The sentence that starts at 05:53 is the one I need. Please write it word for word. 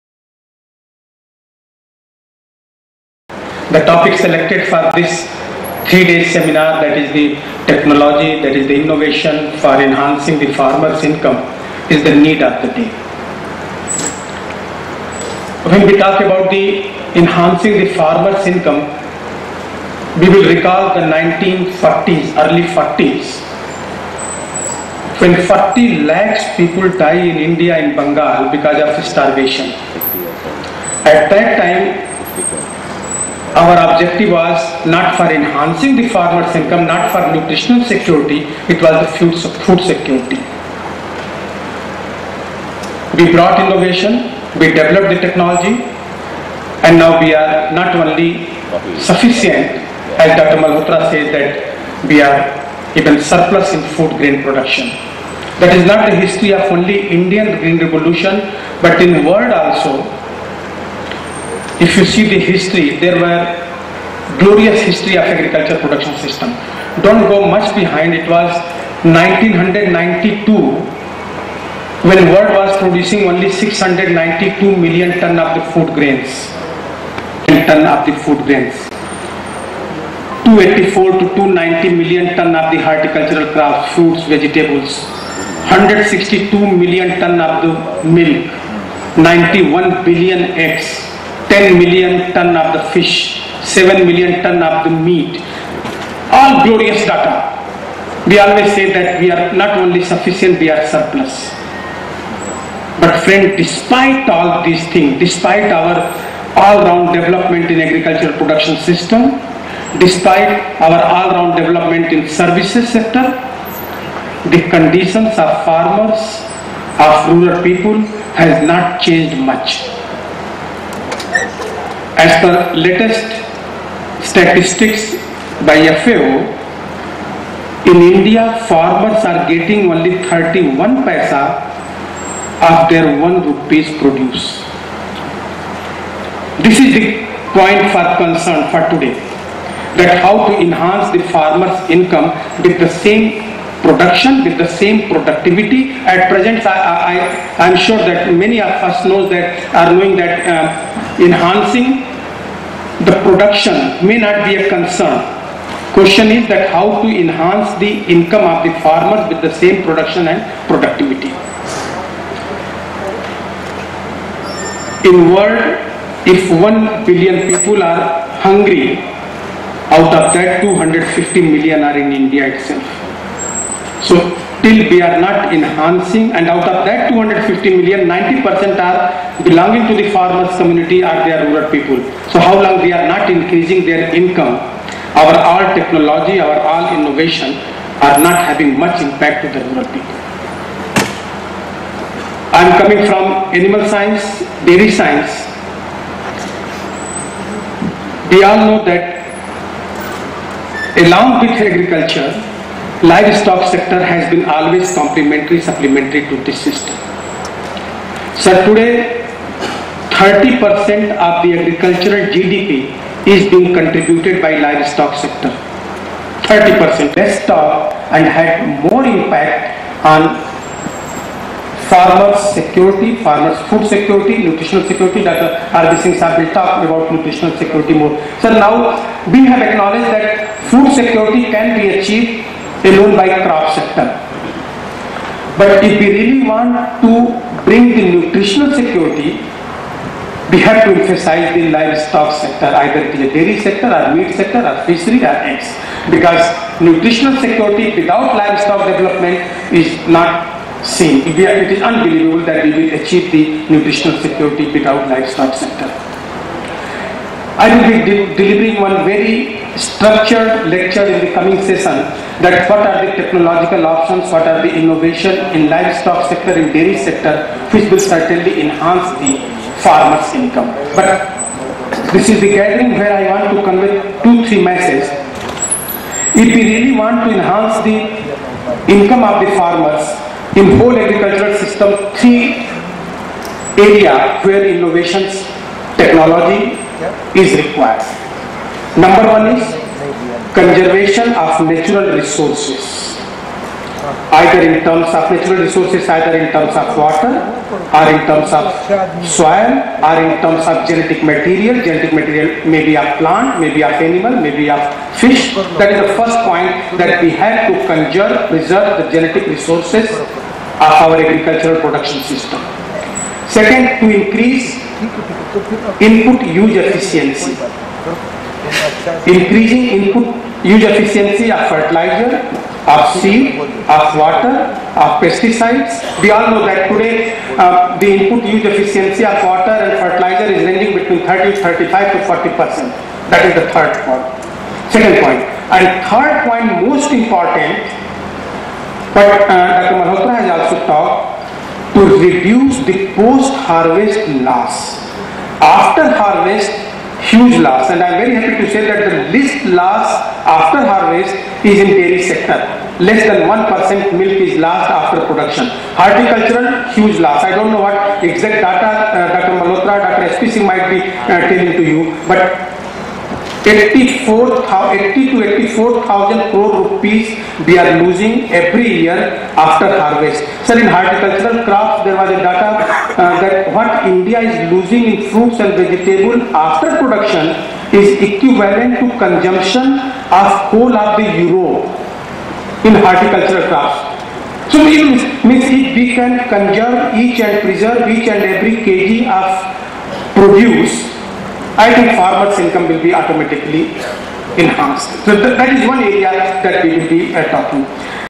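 Less than 1% milk is lost after production.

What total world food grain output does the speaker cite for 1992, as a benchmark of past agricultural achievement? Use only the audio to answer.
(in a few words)
692 million tons.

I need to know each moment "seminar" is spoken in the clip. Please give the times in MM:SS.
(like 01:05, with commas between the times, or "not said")
00:06.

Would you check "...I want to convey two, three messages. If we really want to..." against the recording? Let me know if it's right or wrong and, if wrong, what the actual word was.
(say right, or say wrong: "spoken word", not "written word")
right.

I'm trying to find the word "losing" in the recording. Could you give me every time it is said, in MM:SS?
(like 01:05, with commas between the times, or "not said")
06:08, 06:14.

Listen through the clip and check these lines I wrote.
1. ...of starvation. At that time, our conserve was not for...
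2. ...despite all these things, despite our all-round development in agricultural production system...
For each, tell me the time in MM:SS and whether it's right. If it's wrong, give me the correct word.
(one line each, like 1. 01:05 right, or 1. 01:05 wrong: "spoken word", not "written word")
1. 00:28 wrong: "objective", not "conserve"
2. 01:43 right.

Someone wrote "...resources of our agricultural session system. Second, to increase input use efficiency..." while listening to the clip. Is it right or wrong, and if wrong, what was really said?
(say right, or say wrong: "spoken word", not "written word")
wrong: "production", not "session".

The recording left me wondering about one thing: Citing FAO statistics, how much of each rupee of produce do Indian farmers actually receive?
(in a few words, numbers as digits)
31 paisa.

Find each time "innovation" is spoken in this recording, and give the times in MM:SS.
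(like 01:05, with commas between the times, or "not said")
00:08, 00:43, 03:06, 04:24, 04:44.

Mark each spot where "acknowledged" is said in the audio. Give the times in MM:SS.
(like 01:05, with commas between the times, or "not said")
03:49.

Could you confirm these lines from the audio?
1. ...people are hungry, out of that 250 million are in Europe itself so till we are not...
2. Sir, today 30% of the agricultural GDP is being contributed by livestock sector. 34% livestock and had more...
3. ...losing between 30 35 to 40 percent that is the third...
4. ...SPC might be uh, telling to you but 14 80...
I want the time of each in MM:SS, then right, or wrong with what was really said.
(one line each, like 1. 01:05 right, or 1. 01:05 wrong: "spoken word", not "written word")
1. 02:47 wrong: "India", not "Europe"
2. 03:28 wrong: "30", not "34"
3. 05:30 wrong: "ranging", not "losing"
4. 06:00 wrong: "84", not "14".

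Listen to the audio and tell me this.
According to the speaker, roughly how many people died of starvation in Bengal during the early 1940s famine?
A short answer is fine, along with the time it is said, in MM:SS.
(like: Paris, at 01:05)
40 lakhs, at 00:25.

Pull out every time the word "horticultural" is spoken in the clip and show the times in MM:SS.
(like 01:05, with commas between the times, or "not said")
01:22, 05:55, 06:10, 06:22.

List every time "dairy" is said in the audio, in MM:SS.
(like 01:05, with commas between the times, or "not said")
03:14, 04:03, 04:26, 05:51.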